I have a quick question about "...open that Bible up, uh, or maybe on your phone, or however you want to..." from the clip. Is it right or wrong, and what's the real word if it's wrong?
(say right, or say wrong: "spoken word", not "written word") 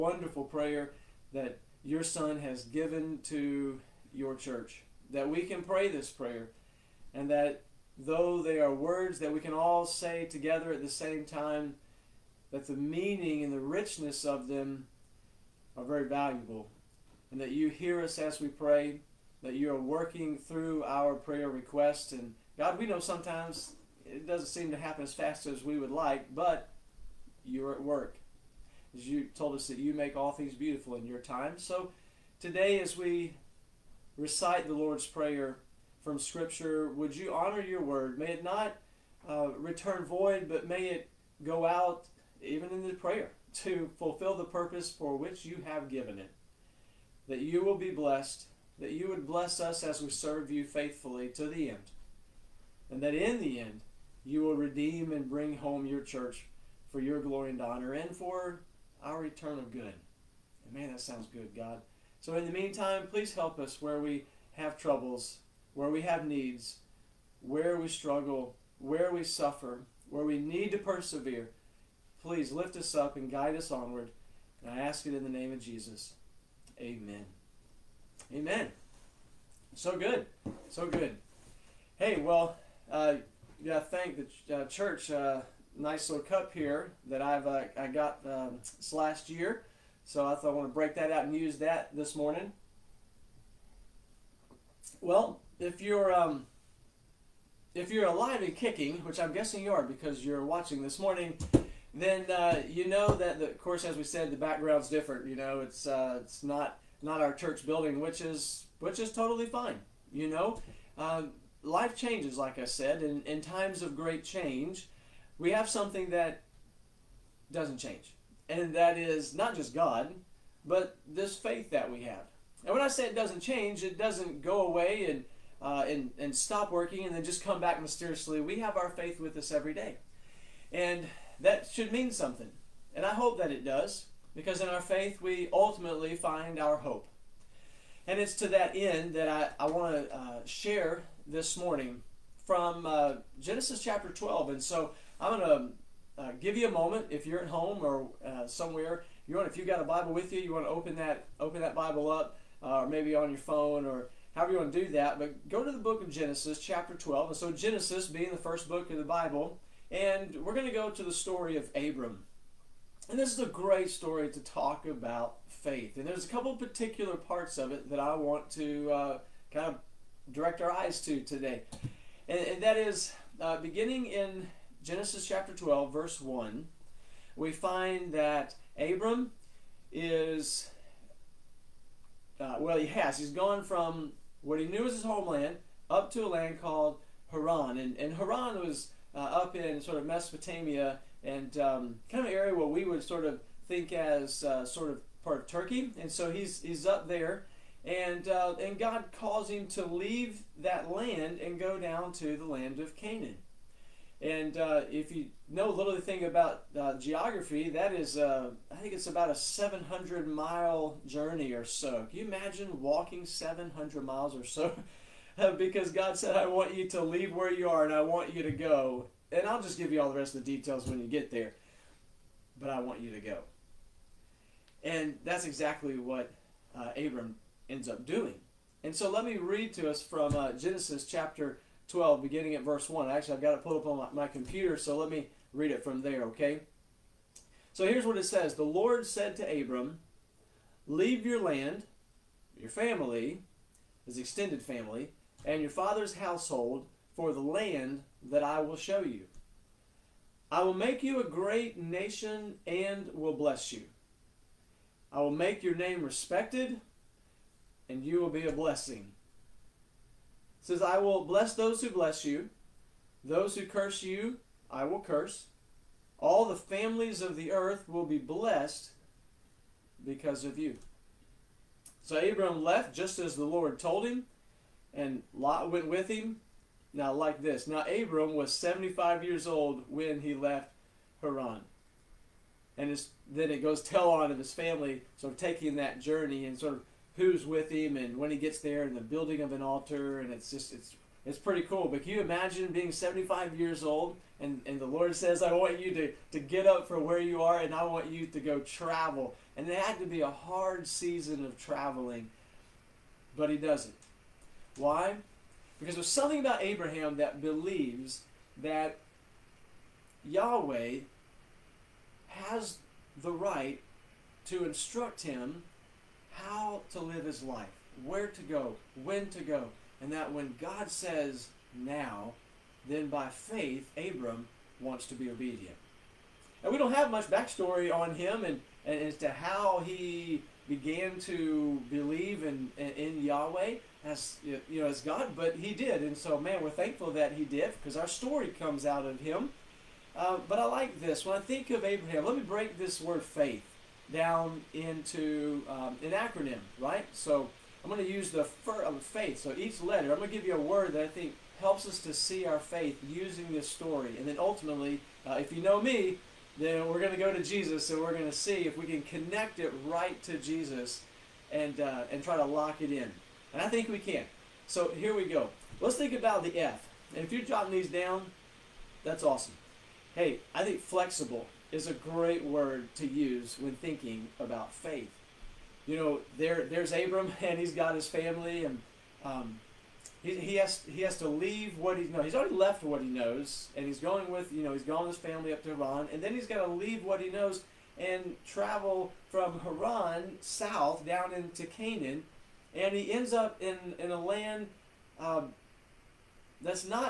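right.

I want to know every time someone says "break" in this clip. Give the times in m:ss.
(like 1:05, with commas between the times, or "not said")
1:30, 5:42.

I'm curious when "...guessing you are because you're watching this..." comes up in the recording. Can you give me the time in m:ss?
1:39.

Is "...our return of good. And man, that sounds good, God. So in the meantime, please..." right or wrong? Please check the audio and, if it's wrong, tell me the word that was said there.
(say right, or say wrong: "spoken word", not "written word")
right.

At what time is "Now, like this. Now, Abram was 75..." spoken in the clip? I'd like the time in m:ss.
4:36.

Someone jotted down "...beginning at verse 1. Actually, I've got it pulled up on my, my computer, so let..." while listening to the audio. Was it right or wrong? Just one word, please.
right.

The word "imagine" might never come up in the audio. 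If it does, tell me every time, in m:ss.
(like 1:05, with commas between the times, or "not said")
3:32, 4:52.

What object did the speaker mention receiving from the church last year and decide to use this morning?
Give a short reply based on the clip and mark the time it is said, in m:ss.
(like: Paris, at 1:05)
cup, at 1:26.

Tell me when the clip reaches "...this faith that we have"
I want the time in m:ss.
2:01.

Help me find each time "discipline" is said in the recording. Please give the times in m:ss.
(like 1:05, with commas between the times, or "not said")
not said.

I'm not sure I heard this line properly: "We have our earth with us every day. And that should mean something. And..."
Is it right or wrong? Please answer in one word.
wrong.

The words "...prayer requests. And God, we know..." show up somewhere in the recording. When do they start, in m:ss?
0:21.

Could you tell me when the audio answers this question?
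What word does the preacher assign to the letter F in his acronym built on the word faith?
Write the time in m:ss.
6:10.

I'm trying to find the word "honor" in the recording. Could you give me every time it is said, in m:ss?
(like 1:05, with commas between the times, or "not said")
0:37, 0:57.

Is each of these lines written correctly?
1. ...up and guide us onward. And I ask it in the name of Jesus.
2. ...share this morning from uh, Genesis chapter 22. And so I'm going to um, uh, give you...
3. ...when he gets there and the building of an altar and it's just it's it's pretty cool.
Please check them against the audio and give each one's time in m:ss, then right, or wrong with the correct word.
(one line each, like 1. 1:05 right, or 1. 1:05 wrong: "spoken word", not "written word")
1. 1:12 right
2. 2:20 wrong: "12", not "22"
3. 4:48 right.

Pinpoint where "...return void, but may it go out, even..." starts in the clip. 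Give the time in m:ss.
0:39.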